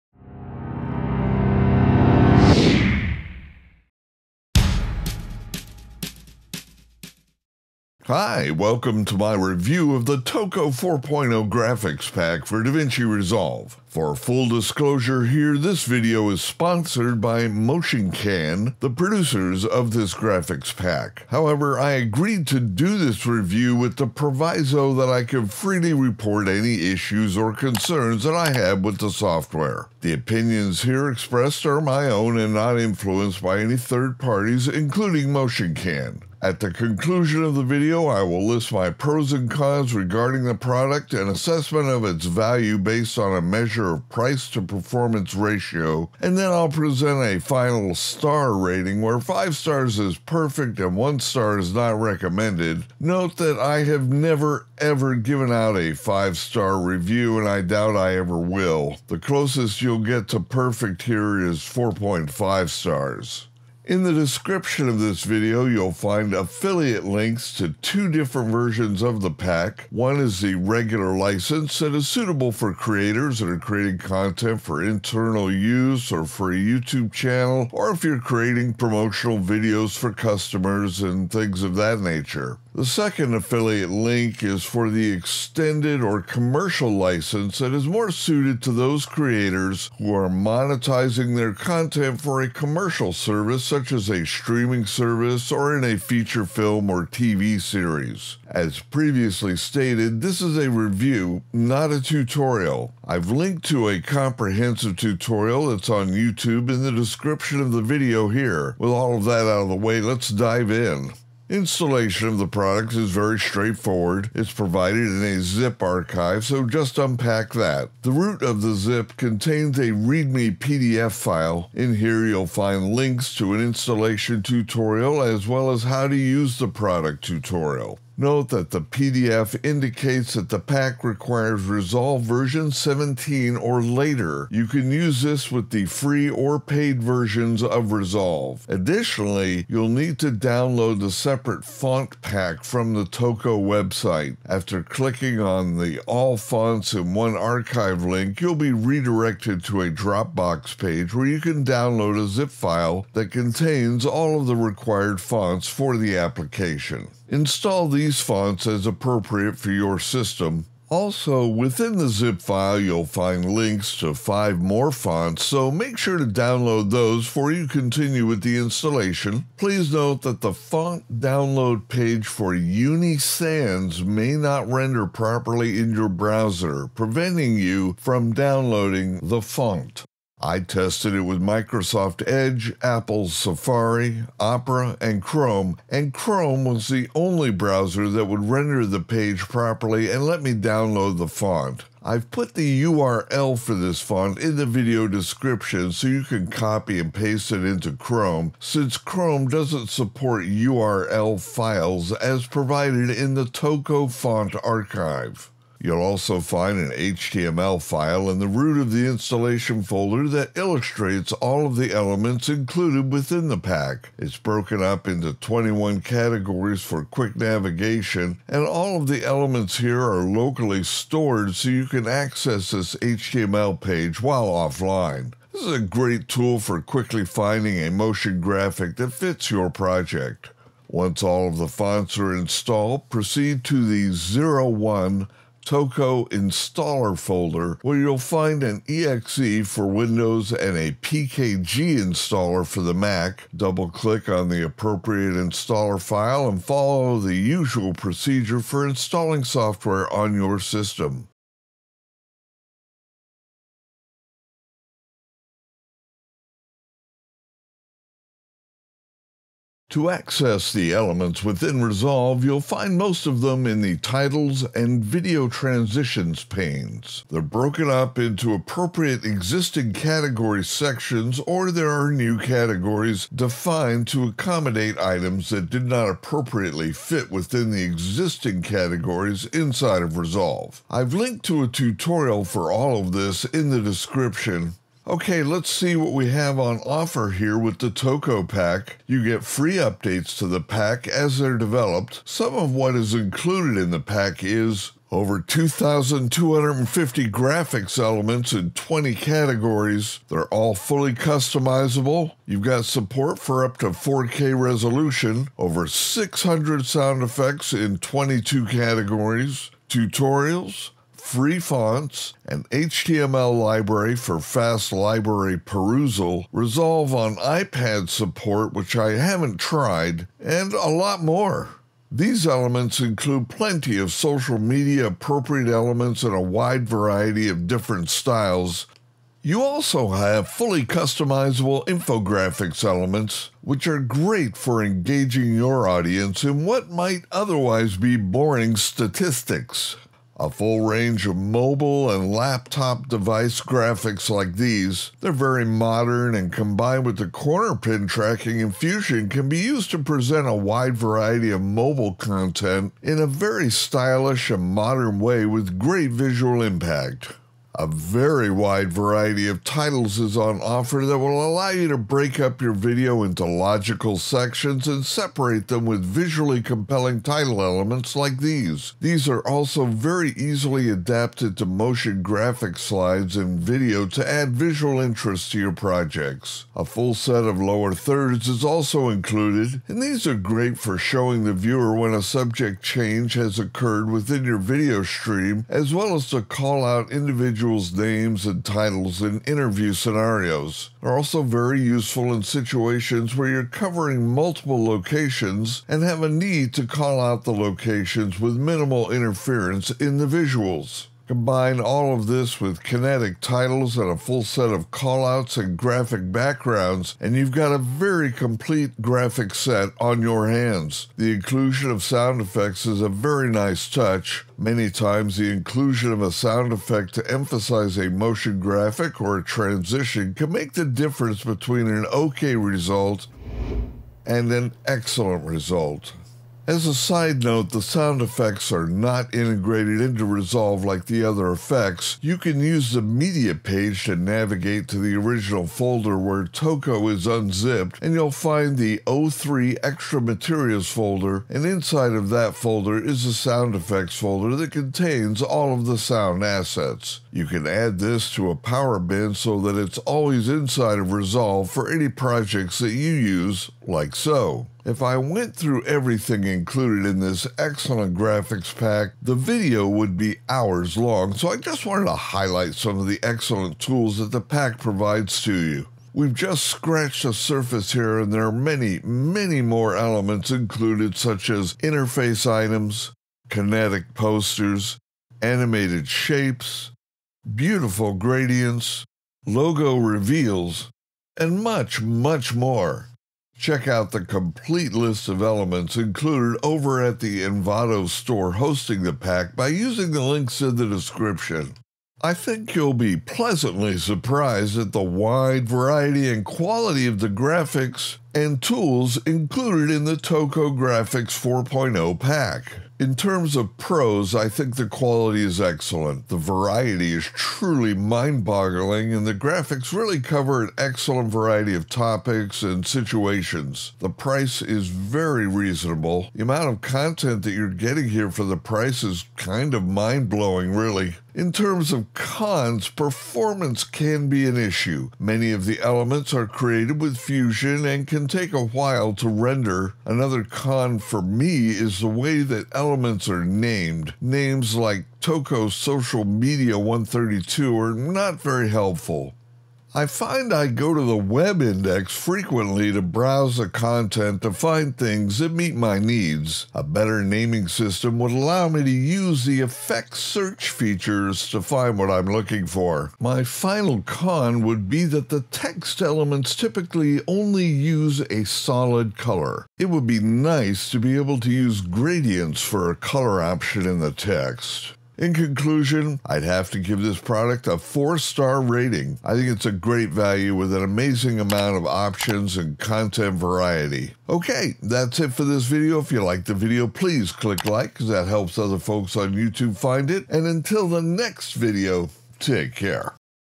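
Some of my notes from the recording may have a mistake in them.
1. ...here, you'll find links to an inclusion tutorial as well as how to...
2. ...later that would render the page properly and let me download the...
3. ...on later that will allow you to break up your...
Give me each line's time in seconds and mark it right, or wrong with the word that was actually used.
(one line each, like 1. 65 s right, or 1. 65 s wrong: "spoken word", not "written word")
1. 121 s wrong: "installation", not "inclusion"
2. 187 s wrong: "browser", not "later"
3. 360 s wrong: "offer", not "later".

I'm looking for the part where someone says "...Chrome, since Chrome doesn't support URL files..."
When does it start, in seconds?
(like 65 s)
197 s.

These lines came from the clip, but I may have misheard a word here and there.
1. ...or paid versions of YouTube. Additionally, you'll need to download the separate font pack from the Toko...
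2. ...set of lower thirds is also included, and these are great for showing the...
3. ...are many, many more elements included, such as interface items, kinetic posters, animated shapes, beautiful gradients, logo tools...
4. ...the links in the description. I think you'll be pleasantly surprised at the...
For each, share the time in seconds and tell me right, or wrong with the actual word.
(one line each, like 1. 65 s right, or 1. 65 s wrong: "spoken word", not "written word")
1. 136 s wrong: "Resolve", not "YouTube"
2. 377 s right
3. 468 s wrong: "reveals", not "tools"
4. 490 s right.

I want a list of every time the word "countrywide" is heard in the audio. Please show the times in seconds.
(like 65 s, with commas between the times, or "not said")
not said.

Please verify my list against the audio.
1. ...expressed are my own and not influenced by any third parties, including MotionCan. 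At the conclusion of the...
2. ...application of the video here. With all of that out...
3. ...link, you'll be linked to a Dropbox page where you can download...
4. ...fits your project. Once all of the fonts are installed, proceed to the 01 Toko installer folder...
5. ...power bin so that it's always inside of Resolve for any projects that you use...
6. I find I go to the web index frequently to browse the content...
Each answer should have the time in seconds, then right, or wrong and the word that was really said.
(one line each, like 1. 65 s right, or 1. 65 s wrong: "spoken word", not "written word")
1. 31 s right
2. 106 s wrong: "description", not "application"
3. 148 s wrong: "redirected", not "linked"
4. 229 s right
5. 448 s right
6. 539 s right.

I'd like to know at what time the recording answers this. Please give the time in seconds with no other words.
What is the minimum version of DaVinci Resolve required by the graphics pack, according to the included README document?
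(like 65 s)
132 s.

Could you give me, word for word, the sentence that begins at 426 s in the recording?
As a side note, the sound effects are not integrated into Resolve like the other effects.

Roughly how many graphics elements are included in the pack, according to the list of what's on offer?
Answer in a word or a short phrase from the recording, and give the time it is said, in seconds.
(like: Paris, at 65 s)
over 2,250, at 295 s.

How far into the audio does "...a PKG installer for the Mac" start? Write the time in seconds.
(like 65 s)
240 s.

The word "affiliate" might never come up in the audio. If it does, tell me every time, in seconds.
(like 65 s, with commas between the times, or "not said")
66 s, 83 s.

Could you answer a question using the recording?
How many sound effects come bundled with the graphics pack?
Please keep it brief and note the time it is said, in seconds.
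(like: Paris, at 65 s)
over 600, at 305 s.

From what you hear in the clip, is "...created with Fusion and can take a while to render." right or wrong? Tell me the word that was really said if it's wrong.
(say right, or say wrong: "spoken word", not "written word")
right.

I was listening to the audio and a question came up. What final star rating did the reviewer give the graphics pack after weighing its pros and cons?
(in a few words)
4 stars.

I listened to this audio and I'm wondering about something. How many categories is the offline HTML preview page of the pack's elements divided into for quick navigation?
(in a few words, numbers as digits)
21.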